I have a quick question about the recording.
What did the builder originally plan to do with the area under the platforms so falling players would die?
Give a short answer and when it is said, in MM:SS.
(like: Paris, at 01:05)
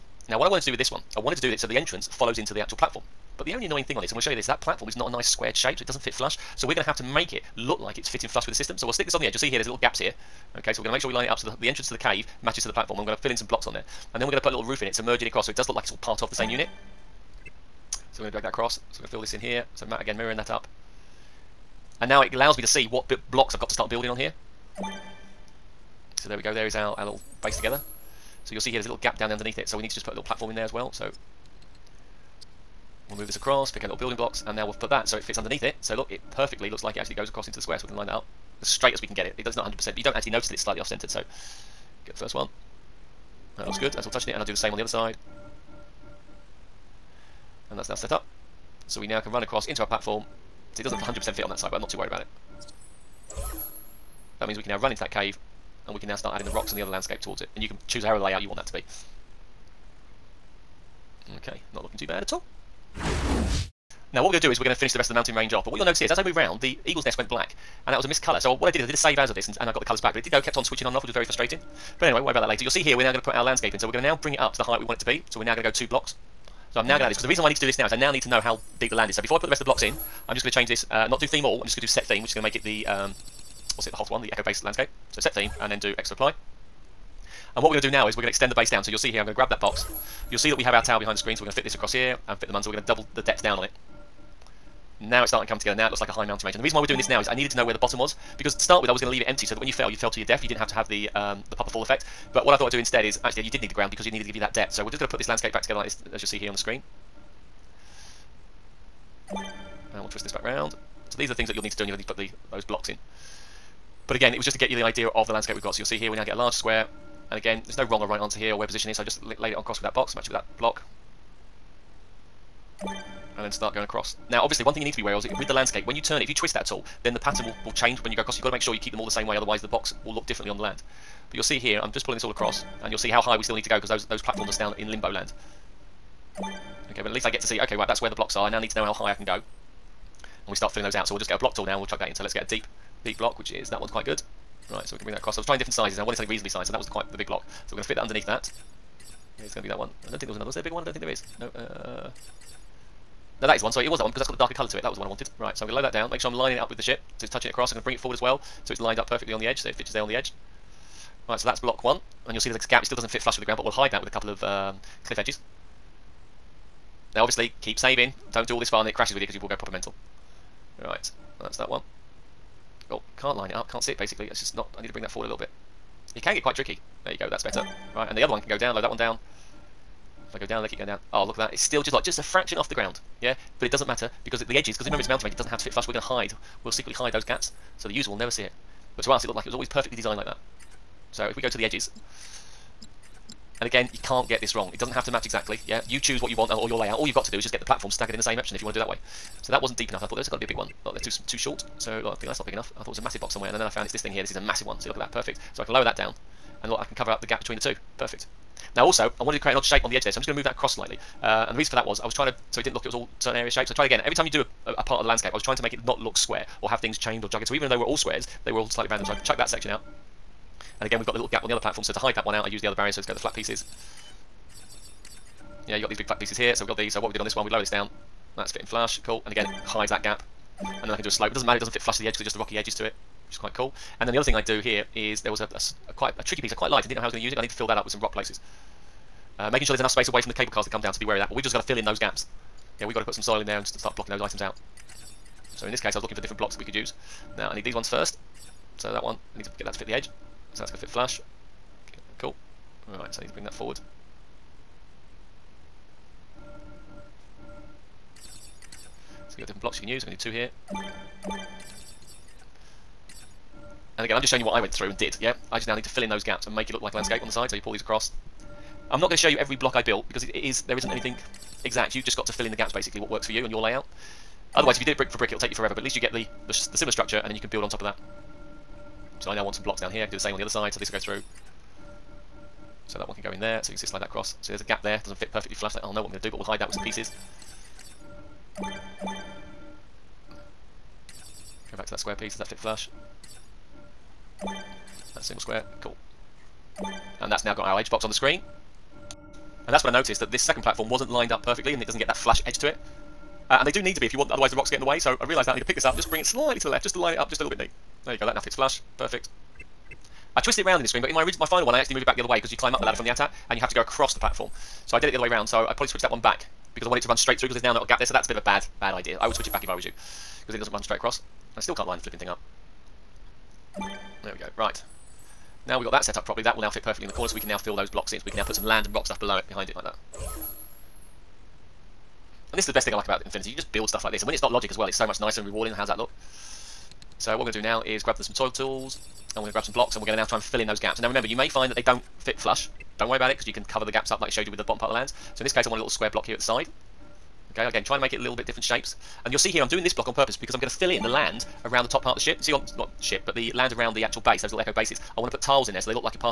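leave it empty, at 01:39.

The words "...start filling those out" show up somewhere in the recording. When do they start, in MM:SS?
02:20.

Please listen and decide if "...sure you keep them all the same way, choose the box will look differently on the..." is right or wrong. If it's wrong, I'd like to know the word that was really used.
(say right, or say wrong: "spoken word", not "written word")
wrong: "otherwise", not "choose".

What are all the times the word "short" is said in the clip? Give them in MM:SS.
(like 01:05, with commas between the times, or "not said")
03:21.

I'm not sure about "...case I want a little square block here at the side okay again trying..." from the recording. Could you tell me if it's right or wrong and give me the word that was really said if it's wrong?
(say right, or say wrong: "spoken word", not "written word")
right.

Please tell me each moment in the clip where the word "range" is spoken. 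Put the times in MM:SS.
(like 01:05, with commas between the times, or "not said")
01:05, 01:36, 03:05.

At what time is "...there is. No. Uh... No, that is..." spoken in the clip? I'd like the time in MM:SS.
02:31.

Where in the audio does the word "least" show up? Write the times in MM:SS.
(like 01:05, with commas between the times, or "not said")
02:17, 04:35.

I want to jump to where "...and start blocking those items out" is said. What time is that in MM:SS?
04:03.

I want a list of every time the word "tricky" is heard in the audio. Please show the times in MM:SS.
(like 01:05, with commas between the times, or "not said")
02:56, 03:56.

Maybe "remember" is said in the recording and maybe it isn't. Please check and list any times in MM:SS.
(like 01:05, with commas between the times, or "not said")
03:04, 05:41.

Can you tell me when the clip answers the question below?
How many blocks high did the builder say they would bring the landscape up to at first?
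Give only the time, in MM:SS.
01:15.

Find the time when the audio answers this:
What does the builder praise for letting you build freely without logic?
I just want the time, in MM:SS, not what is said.
05:33.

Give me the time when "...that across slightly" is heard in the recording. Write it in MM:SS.
03:30.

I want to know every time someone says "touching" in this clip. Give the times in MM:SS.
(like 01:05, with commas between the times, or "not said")
00:44, 02:37.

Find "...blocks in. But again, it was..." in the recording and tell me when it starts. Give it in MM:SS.
01:52.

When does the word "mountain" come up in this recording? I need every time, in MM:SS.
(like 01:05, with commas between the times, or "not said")
01:05, 01:36, 03:05.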